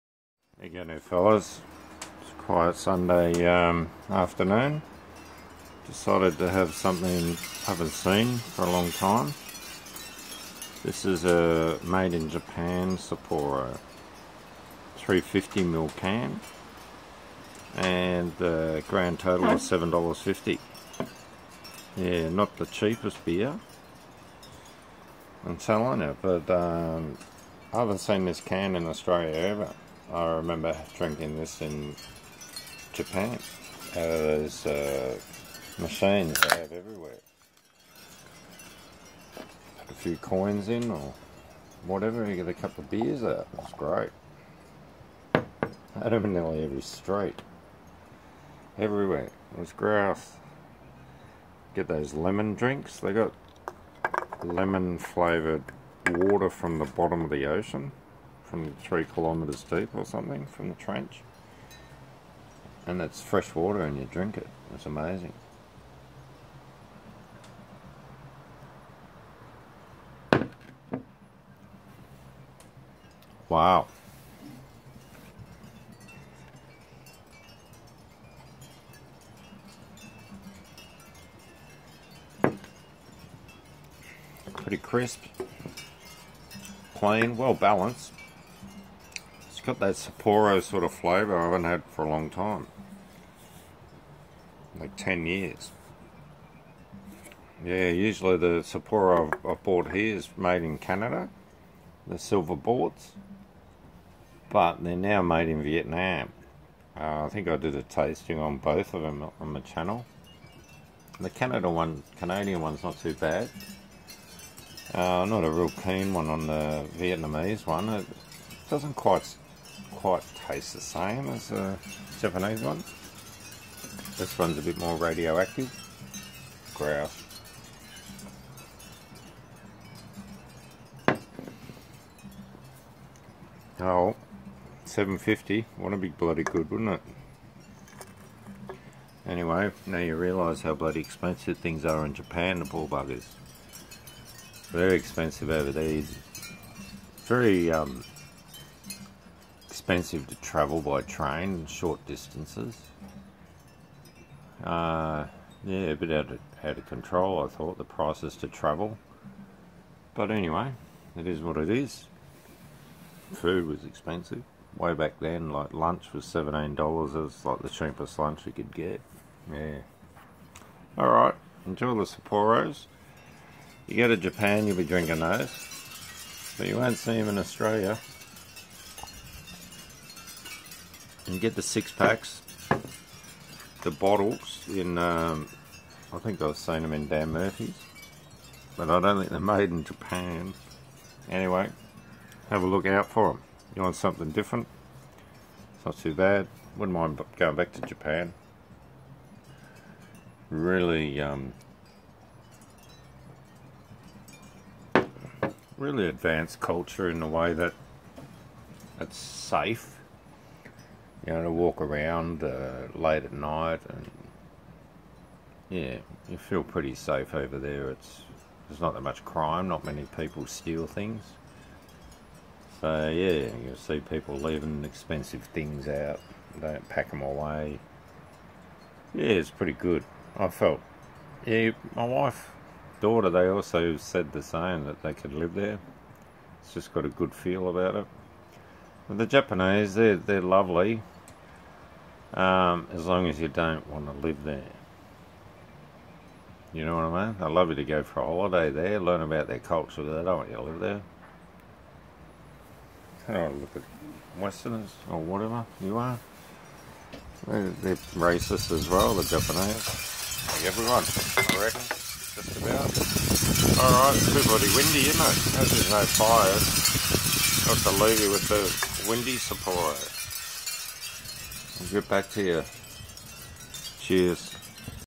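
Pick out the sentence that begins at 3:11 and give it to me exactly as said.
Anyway, have a look out for them.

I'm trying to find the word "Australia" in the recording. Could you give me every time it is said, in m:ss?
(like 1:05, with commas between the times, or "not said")
0:28, 2:57.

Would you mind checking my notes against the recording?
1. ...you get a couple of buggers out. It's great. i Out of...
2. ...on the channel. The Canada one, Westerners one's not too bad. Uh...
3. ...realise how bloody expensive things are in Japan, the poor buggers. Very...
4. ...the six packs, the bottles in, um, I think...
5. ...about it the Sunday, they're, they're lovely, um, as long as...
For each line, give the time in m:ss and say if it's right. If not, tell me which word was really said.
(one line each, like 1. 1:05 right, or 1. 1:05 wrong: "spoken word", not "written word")
1. 0:42 wrong: "beers", not "buggers"
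2. 1:49 wrong: "Canadian", not "Westerners"
3. 2:20 right
4. 3:01 right
5. 3:57 wrong: "Japanese", not "Sunday".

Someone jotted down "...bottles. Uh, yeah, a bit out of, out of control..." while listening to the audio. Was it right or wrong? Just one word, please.
wrong.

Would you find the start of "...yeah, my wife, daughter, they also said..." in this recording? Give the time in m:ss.
3:51.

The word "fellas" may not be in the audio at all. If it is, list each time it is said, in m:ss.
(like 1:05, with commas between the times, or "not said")
0:00.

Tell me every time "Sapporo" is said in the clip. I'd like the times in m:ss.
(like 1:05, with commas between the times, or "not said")
0:12, 1:29, 1:38, 2:52, 4:29.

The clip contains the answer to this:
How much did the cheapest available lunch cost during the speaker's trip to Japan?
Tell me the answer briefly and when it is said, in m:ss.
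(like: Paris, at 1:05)
$17, at 2:46.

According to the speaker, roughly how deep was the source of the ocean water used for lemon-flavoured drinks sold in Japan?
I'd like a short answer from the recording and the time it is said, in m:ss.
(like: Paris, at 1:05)
3 kilometres, at 0:58.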